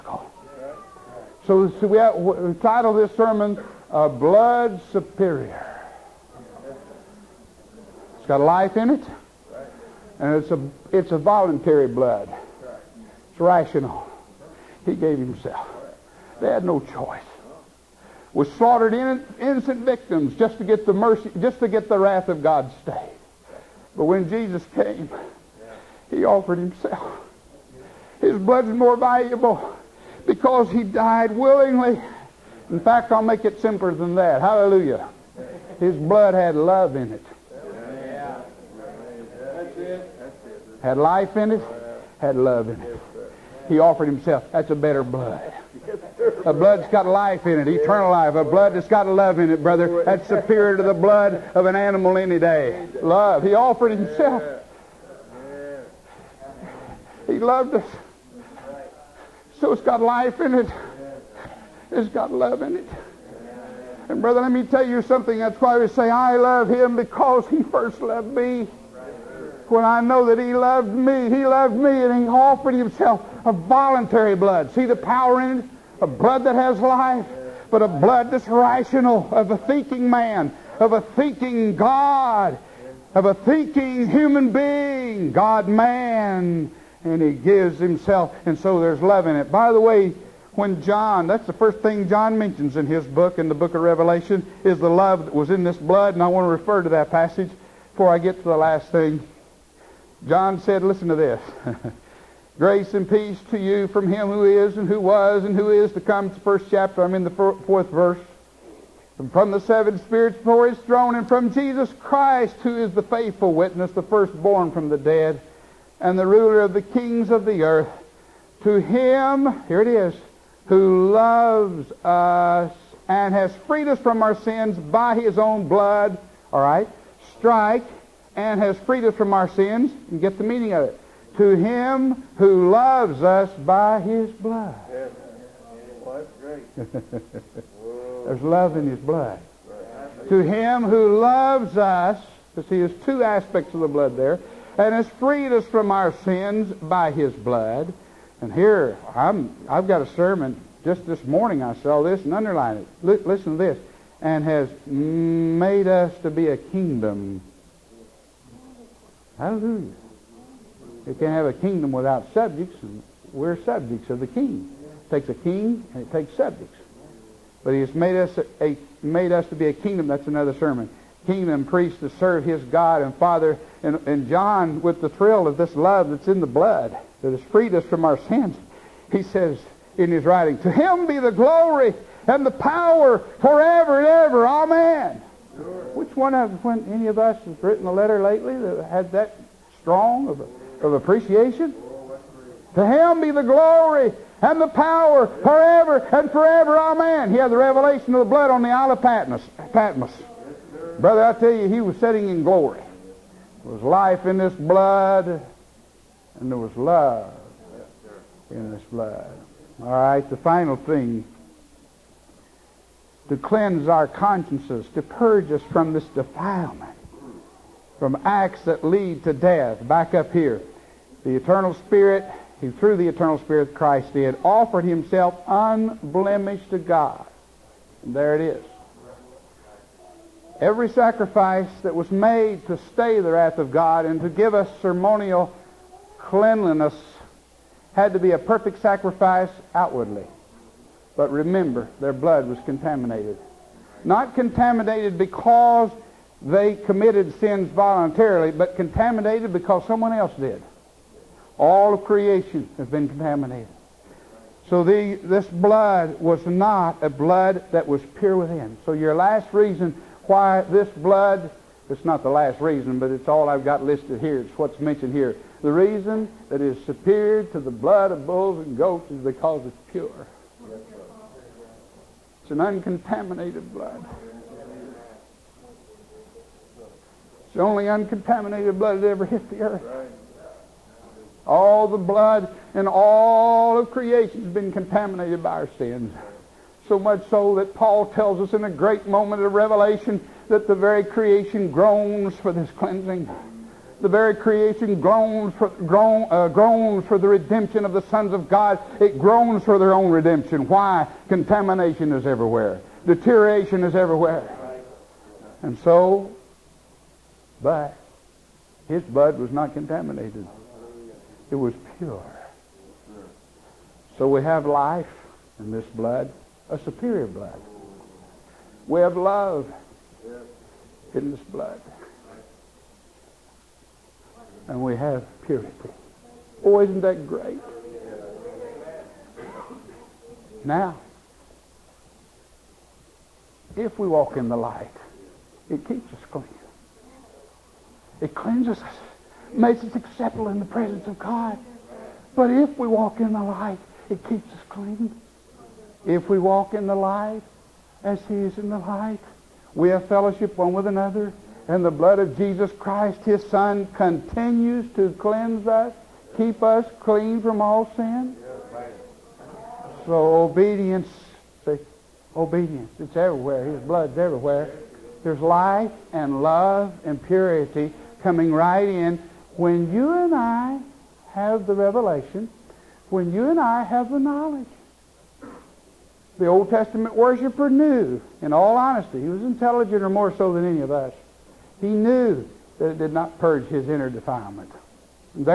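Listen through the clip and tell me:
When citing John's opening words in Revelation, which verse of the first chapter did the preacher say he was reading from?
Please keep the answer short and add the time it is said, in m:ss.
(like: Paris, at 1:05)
4, at 1:47.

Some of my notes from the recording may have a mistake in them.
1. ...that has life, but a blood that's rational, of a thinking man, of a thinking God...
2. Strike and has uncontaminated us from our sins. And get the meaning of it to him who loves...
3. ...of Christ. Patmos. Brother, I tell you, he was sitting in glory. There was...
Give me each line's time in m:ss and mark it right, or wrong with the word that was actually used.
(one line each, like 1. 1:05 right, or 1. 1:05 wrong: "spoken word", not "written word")
1. 1:16 right
2. 2:07 wrong: "freed", not "uncontaminated"
3. 3:18 wrong: "Patmos", not "Christ".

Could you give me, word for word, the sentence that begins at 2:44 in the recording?
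It takes a king and it takes subjects.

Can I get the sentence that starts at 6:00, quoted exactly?
So obedience, see, obedience, it's everywhere.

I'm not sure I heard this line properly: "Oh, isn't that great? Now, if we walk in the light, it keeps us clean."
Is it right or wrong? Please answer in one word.
right.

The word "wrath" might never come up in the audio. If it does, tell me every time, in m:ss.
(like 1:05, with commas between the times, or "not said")
0:21, 3:53.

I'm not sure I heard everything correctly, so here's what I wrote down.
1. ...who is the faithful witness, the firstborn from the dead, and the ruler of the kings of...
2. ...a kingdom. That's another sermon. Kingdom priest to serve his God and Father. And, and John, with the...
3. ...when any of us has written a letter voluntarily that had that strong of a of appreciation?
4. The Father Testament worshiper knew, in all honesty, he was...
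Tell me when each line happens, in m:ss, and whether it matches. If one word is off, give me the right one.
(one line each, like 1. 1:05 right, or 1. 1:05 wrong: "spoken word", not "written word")
1. 1:52 right
2. 2:49 right
3. 3:06 wrong: "lately", not "voluntarily"
4. 6:16 wrong: "Old", not "Father".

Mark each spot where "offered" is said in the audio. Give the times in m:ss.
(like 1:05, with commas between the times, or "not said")
0:26, 0:43, 0:53, 1:12, 3:44.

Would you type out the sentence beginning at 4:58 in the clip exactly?
It groans for their own redemption.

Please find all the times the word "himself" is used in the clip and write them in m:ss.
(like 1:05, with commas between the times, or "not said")
0:15, 0:26, 0:44, 0:53, 1:12, 1:27, 3:44.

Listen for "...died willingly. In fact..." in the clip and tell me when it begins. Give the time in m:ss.
0:30.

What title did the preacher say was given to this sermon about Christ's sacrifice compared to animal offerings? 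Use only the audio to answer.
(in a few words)
Blood Superior.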